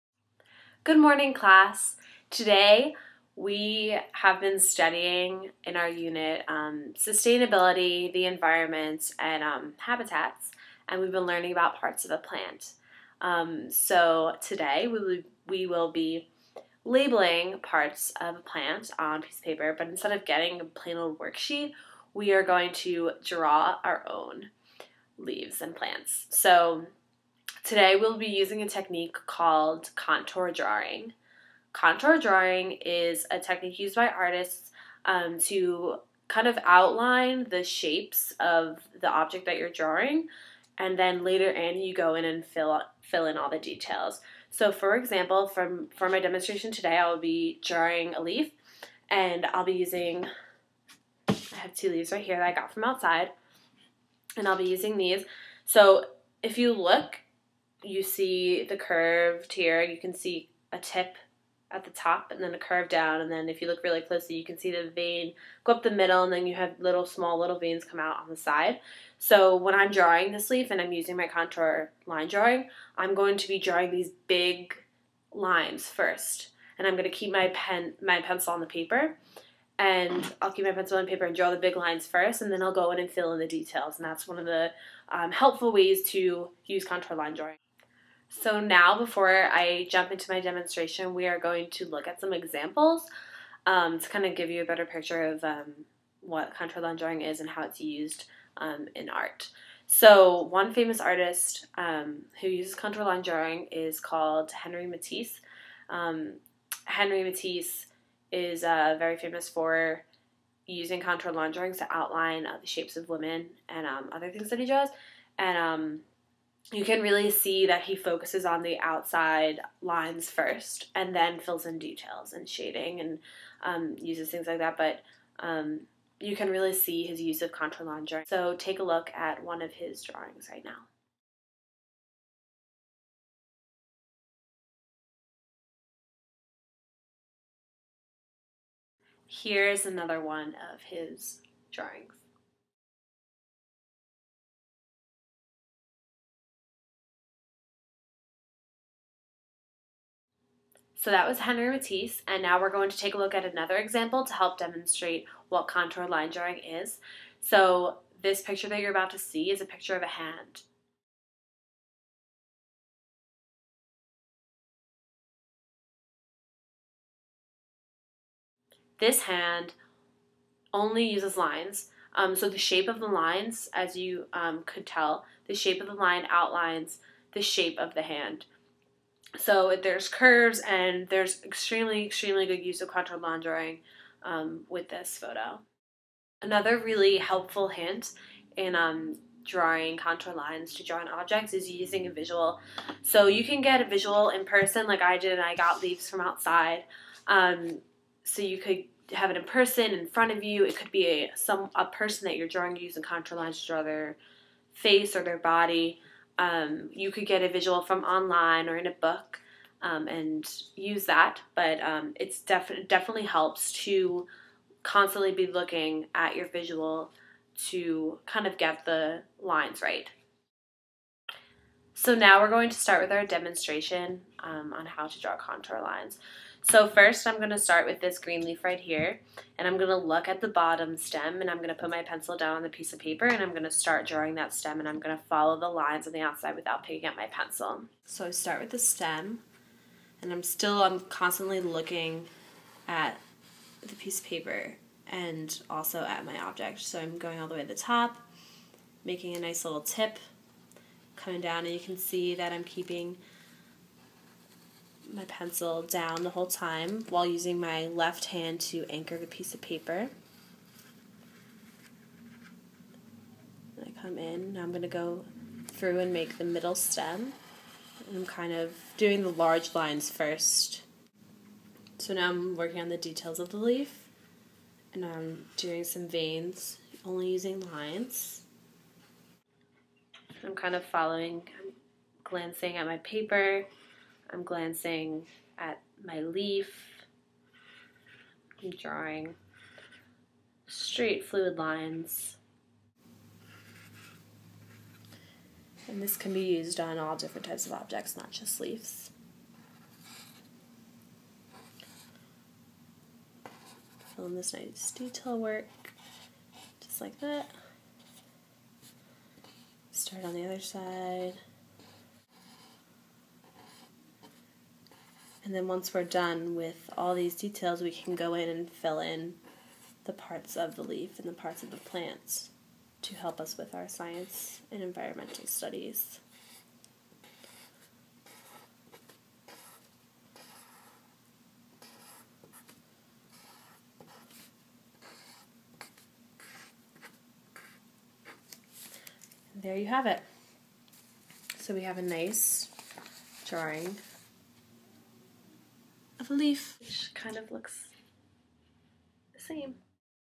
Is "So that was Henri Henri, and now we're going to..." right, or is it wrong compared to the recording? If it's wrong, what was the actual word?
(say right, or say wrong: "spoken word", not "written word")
wrong: "Matisse", not "Henri".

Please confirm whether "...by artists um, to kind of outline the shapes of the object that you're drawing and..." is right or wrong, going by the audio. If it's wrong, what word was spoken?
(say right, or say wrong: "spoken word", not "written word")
right.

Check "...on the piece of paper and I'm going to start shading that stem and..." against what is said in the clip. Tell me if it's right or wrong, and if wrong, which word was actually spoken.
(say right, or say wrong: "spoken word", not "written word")
wrong: "drawing", not "shading".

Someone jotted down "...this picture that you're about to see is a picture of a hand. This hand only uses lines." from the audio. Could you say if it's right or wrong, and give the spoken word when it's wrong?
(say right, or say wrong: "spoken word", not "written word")
right.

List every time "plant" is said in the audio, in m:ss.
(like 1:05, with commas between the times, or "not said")
0:12, 0:18, 0:25, 5:21.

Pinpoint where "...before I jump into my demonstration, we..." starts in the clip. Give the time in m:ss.
1:28.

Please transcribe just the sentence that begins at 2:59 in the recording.
So there's curves and there's extremely, extremely good use of contour line drawing um, with this photo.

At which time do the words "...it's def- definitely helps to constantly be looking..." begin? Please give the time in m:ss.
3:32.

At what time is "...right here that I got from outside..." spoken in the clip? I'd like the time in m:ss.
0:52.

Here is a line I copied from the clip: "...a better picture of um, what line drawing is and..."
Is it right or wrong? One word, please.
right.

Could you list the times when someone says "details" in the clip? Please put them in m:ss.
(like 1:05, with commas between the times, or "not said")
0:43, 1:23, 2:01, 4:32, 5:04, 5:17.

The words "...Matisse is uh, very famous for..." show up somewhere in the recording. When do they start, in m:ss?
1:47.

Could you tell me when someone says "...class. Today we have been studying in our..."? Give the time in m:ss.
0:01.